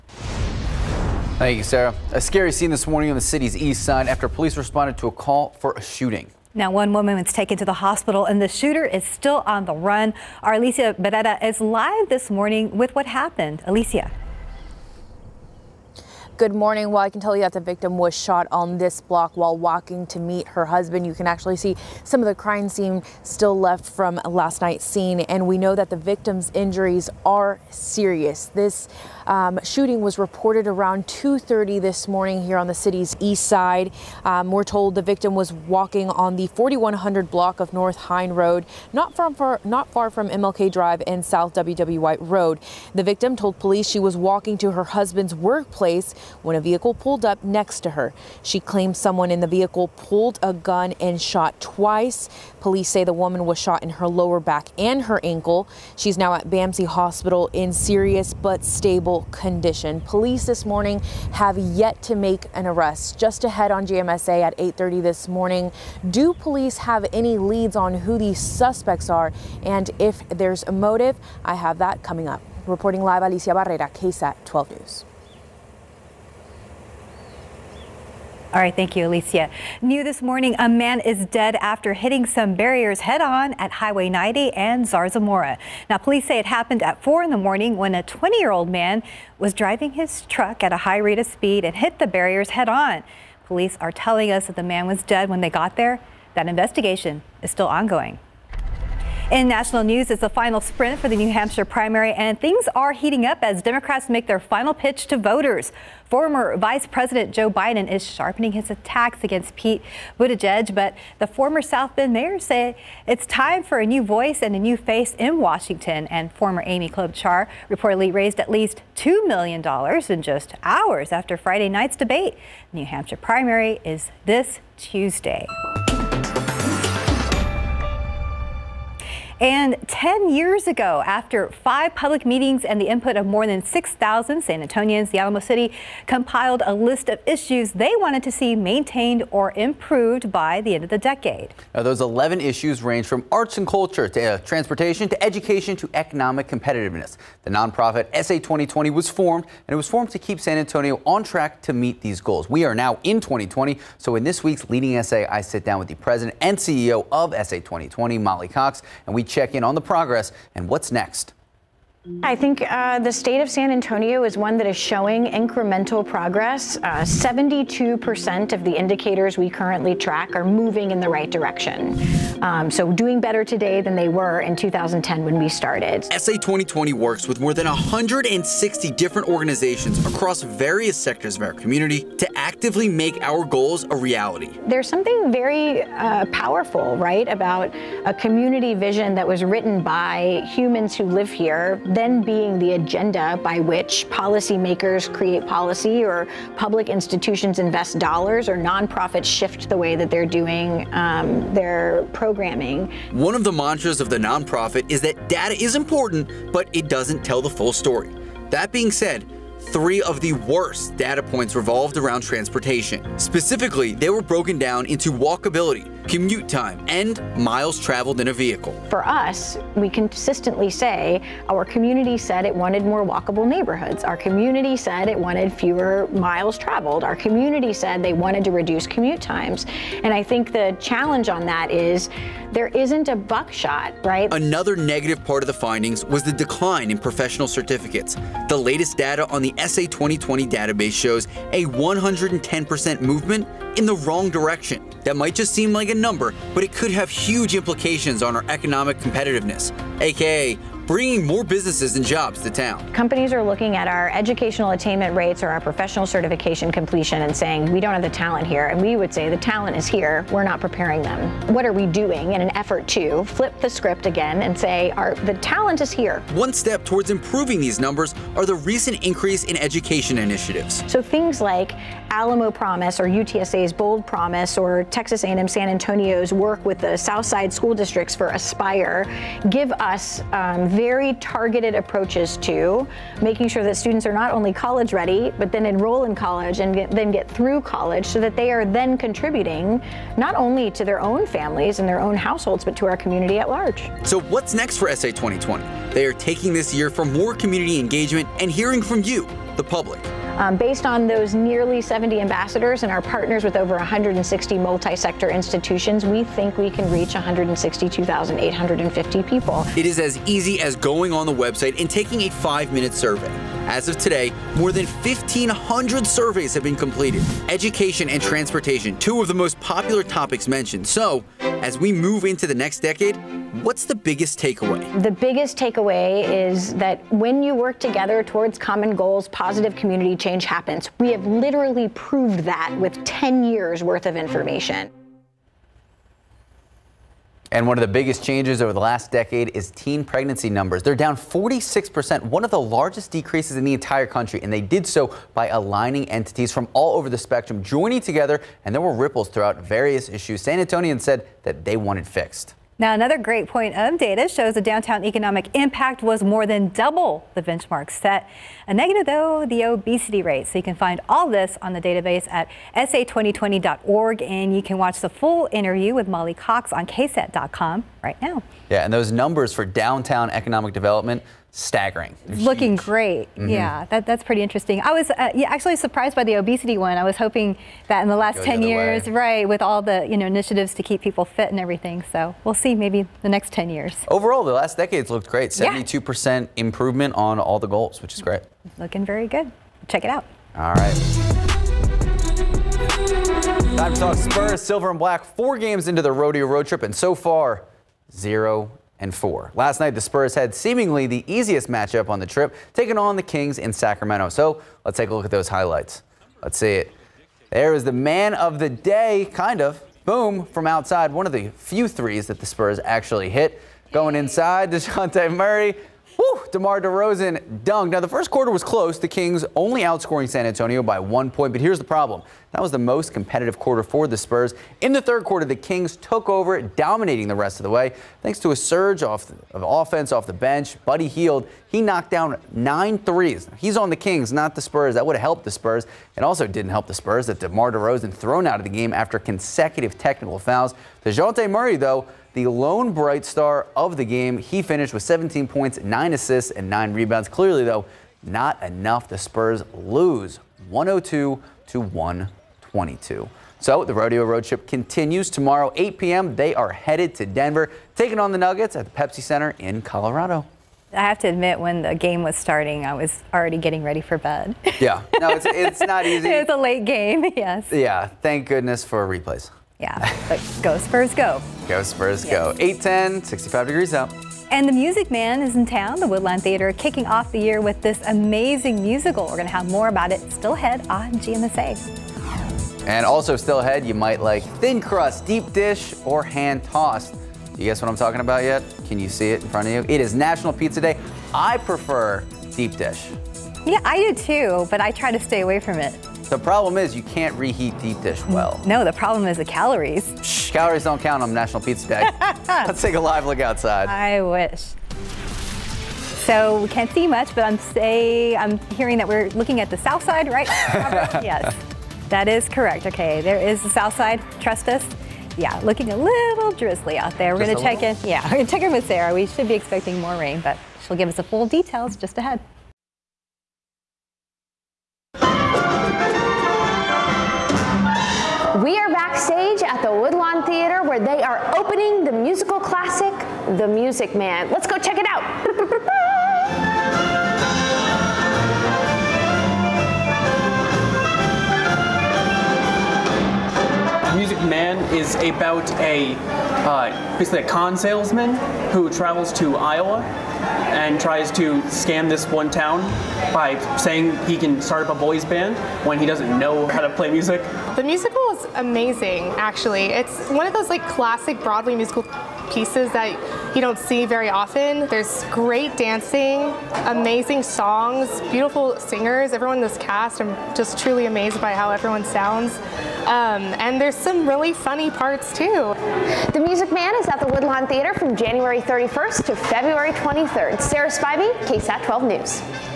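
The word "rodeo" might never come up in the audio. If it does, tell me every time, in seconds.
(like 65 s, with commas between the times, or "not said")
396 s, 453 s.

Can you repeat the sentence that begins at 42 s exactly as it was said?
The victim told police she was walking to her husband's workplace when a vehicle pulled up next to her.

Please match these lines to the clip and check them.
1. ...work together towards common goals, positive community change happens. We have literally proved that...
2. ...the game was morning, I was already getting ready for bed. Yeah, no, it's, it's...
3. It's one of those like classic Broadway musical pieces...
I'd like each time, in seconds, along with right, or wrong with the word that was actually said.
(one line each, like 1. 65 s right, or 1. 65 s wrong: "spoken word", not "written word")
1. 327 s right
2. 461 s wrong: "starting", not "morning"
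3. 559 s right.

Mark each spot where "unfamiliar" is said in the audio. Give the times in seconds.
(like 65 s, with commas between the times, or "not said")
not said.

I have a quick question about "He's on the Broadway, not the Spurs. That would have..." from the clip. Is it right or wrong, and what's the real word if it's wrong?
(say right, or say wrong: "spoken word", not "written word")
wrong: "Kings", not "Broadway".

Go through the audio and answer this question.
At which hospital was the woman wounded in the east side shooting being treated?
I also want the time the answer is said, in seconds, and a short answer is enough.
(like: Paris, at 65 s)
BAMC, at 56 s.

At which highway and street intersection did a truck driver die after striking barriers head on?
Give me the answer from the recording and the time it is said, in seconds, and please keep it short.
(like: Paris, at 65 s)
Highway 90 and Zarzamora, at 83 s.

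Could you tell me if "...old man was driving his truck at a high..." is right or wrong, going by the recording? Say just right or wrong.
right.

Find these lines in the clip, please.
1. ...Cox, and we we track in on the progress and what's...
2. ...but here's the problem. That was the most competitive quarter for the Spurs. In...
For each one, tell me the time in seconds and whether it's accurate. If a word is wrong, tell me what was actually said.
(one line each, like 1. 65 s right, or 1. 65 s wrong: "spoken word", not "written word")
1. 158 s wrong: "check", not "track"
2. 421 s right.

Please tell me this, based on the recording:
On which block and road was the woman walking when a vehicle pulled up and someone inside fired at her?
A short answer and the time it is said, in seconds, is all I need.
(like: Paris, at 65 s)
4100 block of North Hine Road, at 36 s.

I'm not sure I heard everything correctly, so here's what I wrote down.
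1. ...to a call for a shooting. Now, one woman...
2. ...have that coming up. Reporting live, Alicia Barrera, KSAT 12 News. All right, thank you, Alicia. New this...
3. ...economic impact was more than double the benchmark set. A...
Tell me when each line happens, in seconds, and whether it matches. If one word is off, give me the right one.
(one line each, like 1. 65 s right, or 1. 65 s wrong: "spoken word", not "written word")
1. 4 s right
2. 71 s right
3. 355 s right.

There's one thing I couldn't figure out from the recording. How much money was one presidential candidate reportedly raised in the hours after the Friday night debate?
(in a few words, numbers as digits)
$2 million.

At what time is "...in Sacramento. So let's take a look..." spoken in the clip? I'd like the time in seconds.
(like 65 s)
403 s.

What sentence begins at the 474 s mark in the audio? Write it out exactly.
And the Music Man is in town.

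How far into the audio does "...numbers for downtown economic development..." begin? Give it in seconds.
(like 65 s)
369 s.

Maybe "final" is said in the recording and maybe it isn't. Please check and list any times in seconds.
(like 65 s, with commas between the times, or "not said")
100 s, 104 s.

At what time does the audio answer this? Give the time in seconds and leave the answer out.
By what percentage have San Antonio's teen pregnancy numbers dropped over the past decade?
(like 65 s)
341 s.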